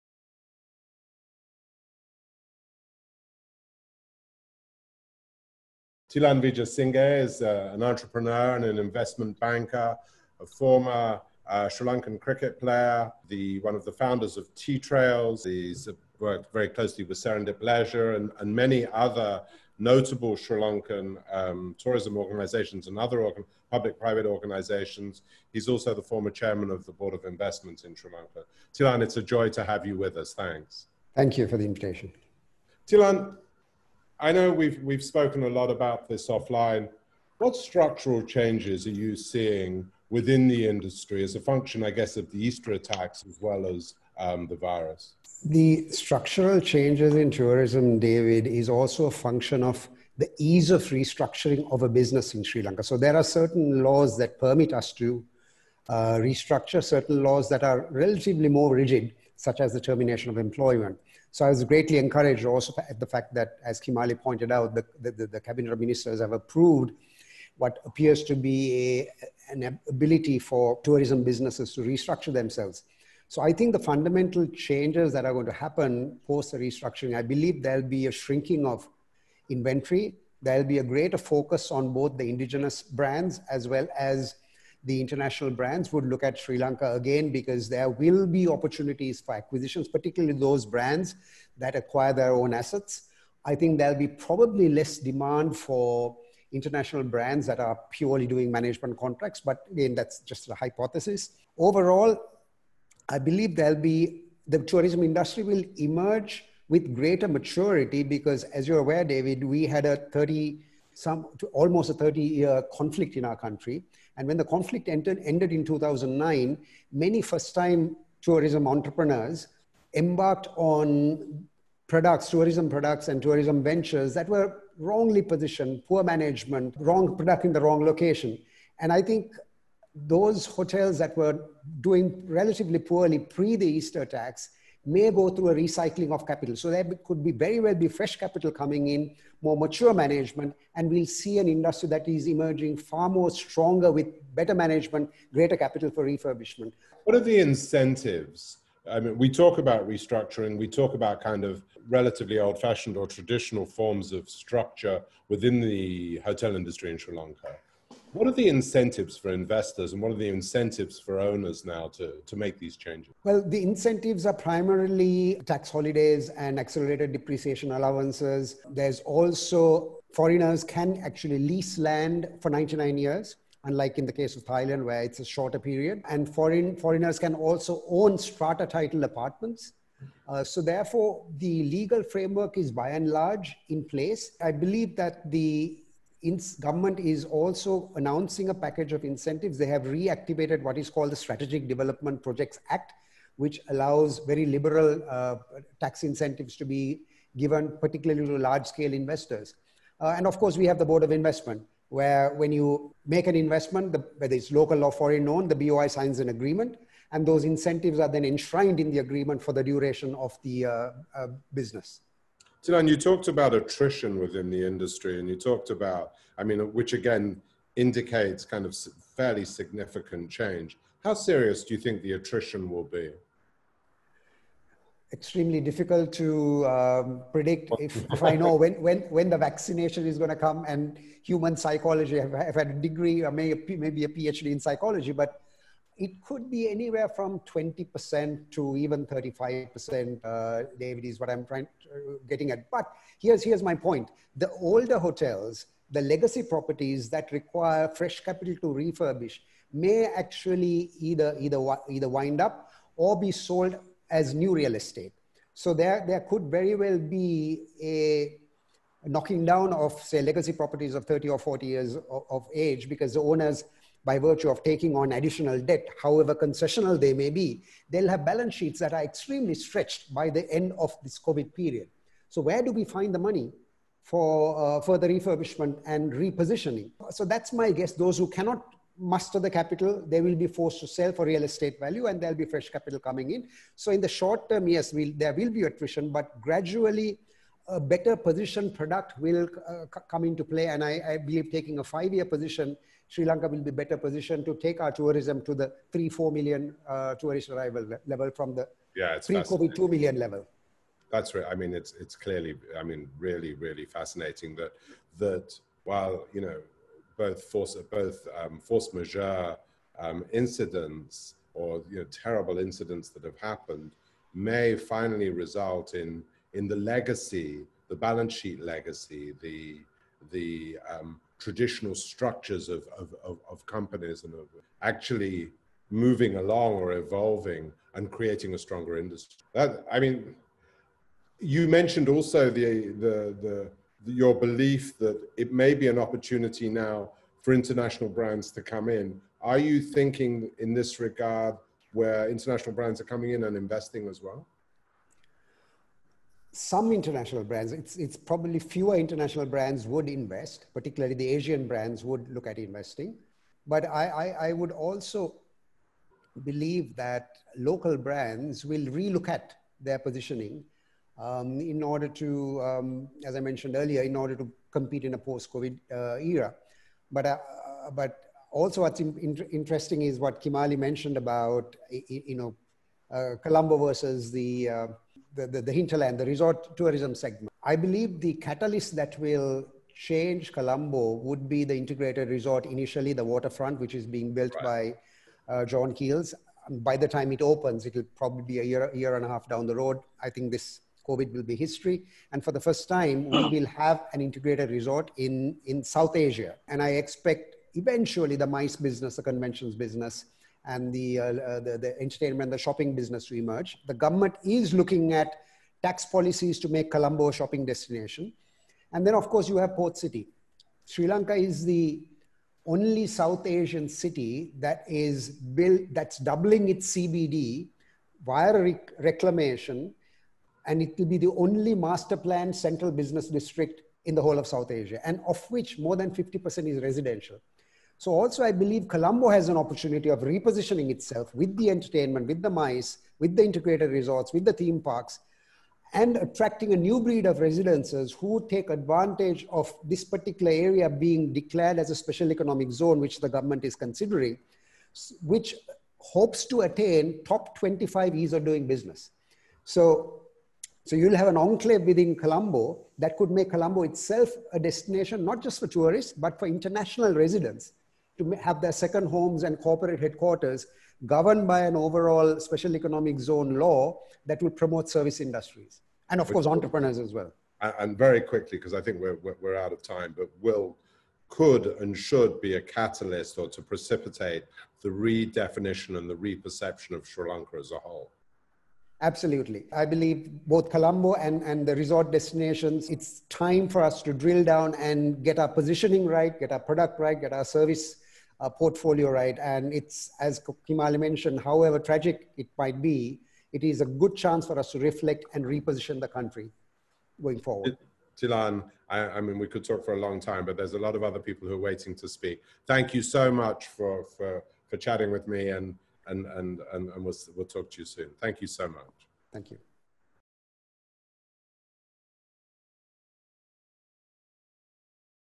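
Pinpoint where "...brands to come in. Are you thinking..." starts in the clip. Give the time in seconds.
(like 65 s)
338 s.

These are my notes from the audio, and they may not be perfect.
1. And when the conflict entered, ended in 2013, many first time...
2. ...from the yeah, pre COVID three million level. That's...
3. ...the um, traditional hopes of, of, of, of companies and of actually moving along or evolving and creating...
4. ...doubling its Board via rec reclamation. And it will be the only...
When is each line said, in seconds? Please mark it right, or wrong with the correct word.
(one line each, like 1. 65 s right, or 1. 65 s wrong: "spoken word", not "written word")
1. 114 s wrong: "2009", not "2013"
2. 298 s wrong: "two", not "three"
3. 320 s wrong: "structures", not "hopes"
4. 416 s wrong: "CBD", not "Board".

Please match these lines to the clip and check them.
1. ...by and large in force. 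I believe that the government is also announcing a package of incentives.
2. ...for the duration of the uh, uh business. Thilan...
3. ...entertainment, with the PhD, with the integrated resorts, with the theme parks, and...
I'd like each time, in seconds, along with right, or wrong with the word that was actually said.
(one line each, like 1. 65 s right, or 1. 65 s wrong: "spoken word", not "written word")
1. 182 s wrong: "place", not "force"
2. 209 s right
3. 431 s wrong: "MICE", not "PhD".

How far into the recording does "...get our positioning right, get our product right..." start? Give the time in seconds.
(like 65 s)
485 s.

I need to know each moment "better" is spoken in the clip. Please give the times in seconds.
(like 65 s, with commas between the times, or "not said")
144 s, 287 s, 293 s.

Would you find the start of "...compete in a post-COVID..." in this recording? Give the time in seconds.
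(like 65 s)
364 s.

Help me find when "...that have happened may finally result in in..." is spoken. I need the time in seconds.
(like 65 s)
313 s.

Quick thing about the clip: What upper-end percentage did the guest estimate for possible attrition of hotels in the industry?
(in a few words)
35%.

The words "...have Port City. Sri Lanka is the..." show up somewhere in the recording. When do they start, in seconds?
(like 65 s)
409 s.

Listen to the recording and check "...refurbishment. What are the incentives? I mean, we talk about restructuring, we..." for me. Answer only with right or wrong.
right.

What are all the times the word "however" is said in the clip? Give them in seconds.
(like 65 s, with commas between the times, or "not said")
266 s, 491 s.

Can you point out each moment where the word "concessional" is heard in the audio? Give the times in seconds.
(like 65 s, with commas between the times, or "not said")
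266 s.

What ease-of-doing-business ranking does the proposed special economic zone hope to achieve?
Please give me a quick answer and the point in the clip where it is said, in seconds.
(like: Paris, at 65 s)
top 25, at 447 s.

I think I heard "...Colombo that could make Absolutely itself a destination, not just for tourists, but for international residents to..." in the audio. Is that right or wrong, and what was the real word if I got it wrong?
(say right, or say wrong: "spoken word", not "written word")
wrong: "Colombo", not "Absolutely".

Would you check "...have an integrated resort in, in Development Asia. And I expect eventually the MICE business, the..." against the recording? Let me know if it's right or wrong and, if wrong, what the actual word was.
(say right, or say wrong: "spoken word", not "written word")
wrong: "South", not "Development".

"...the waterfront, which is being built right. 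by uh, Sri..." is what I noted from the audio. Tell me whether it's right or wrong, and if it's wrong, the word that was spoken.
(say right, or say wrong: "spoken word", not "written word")
wrong: "John", not "Sri".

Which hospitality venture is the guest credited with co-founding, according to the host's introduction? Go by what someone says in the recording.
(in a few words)
Tea Trails.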